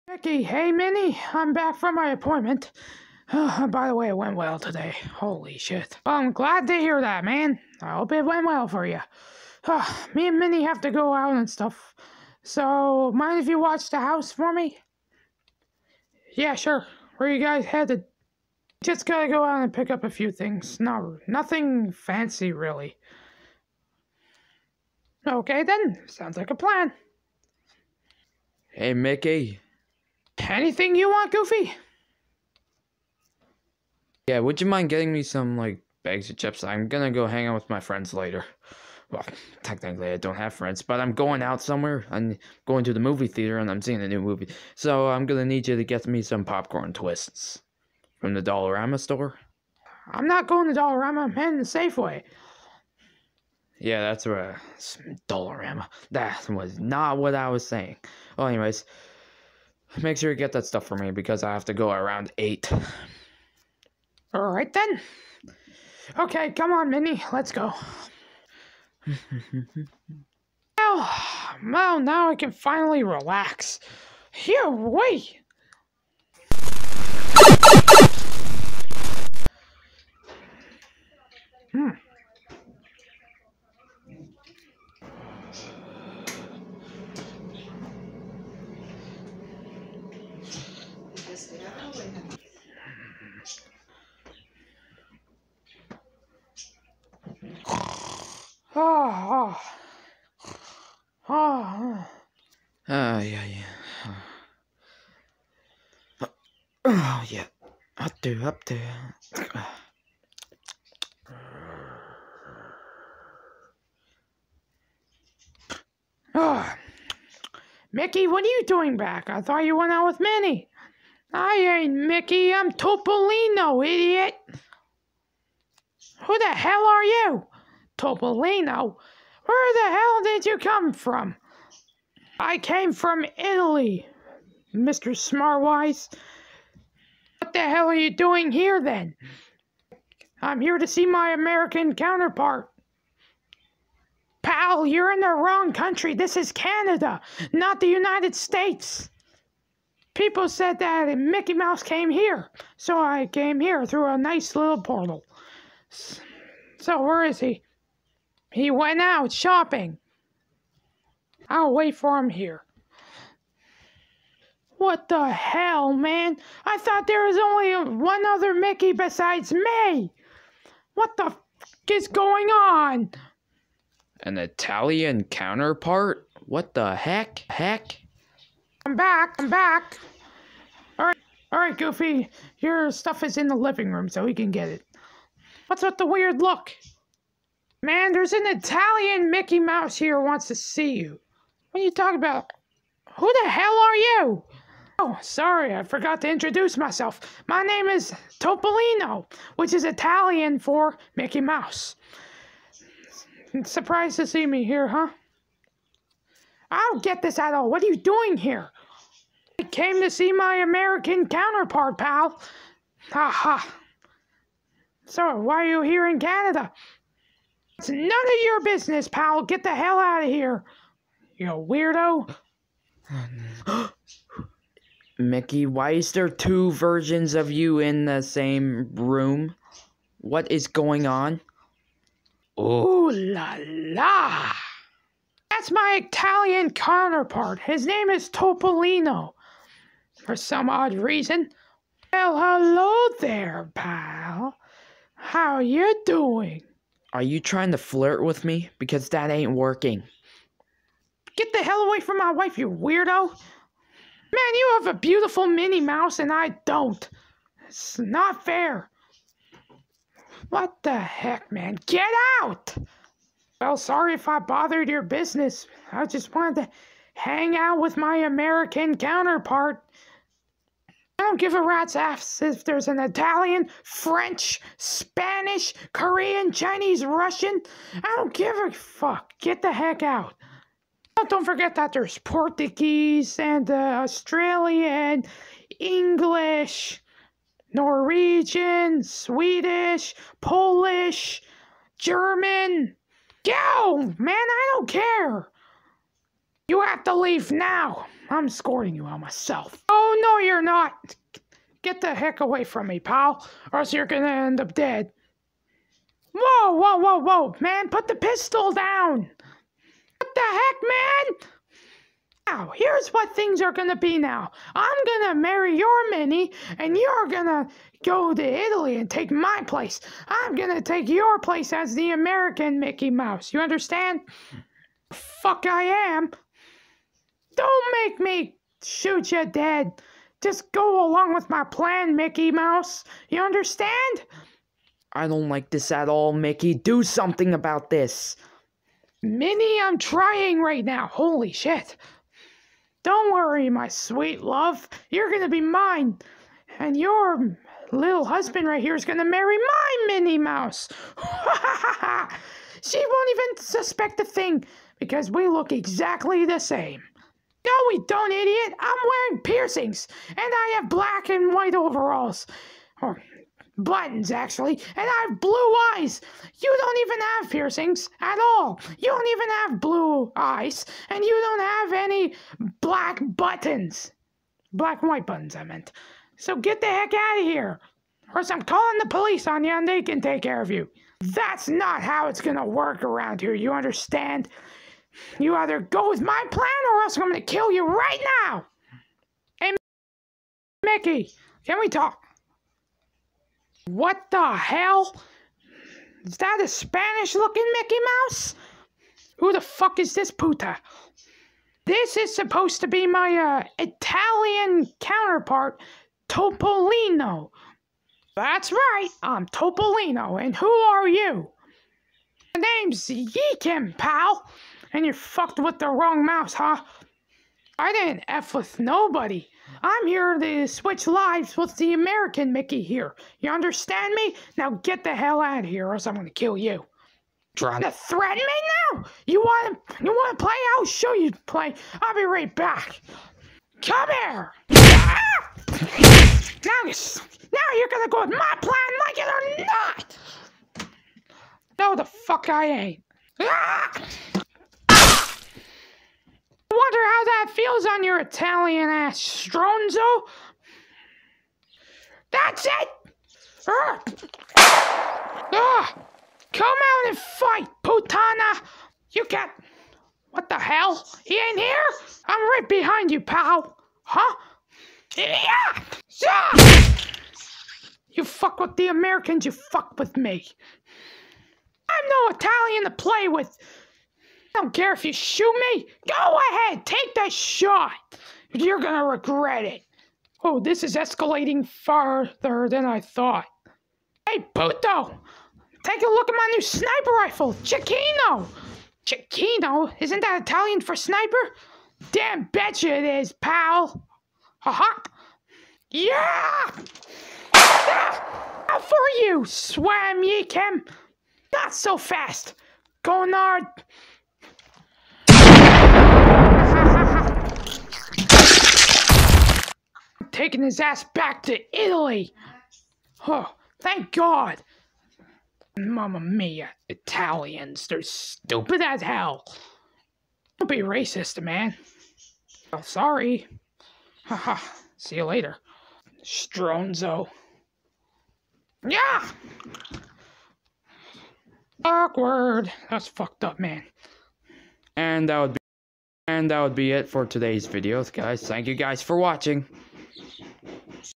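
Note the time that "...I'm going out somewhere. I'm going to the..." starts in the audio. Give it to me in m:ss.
0:41.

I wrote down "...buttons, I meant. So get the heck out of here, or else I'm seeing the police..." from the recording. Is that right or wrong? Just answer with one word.
wrong.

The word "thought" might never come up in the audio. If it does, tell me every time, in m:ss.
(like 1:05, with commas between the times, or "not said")
1:59, 2:46, 8:02.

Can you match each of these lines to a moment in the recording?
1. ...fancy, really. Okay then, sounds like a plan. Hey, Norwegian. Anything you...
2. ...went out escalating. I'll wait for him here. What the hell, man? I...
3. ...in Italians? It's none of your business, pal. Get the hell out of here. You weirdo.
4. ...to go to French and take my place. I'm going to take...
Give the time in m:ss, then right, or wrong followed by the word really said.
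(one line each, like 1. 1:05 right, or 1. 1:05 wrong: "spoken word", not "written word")
1. 0:21 wrong: "Mickey", not "Norwegian"
2. 2:38 wrong: "shopping", not "escalating"
3. 3:36 wrong: "Canada", not "Italians"
4. 5:17 wrong: "Italy", not "French".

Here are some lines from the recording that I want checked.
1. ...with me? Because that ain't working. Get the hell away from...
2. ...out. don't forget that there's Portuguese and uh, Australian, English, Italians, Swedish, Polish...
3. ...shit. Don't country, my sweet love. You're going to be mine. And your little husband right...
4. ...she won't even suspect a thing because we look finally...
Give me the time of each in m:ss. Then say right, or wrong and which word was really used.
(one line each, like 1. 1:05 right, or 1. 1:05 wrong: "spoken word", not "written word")
1. 4:08 right
2. 4:40 wrong: "Norwegian", not "Italians"
3. 5:41 wrong: "worry", not "country"
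4. 5:52 wrong: "exactly", not "finally".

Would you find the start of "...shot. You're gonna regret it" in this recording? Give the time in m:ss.
7:57.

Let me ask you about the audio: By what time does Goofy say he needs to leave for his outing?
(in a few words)
8.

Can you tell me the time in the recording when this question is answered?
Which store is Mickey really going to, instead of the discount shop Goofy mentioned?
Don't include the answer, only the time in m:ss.
0:51.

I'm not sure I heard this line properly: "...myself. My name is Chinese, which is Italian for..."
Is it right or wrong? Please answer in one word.
wrong.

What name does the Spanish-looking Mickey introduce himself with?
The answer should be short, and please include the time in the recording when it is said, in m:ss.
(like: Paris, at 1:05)
Yeekim, at 6:53.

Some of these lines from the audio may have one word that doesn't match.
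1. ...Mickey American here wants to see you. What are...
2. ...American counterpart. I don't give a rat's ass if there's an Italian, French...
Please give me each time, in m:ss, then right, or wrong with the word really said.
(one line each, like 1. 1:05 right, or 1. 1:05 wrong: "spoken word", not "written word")
1. 3:09 wrong: "Mouse", not "American"
2. 4:28 right.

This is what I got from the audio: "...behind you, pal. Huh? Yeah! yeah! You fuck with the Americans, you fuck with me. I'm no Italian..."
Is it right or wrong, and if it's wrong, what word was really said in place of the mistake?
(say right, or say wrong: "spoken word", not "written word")
right.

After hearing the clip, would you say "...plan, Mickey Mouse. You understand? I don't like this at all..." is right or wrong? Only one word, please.
right.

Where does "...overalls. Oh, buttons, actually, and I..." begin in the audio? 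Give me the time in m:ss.
6:01.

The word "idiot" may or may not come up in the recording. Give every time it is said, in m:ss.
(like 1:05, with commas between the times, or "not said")
2:03, 5:58.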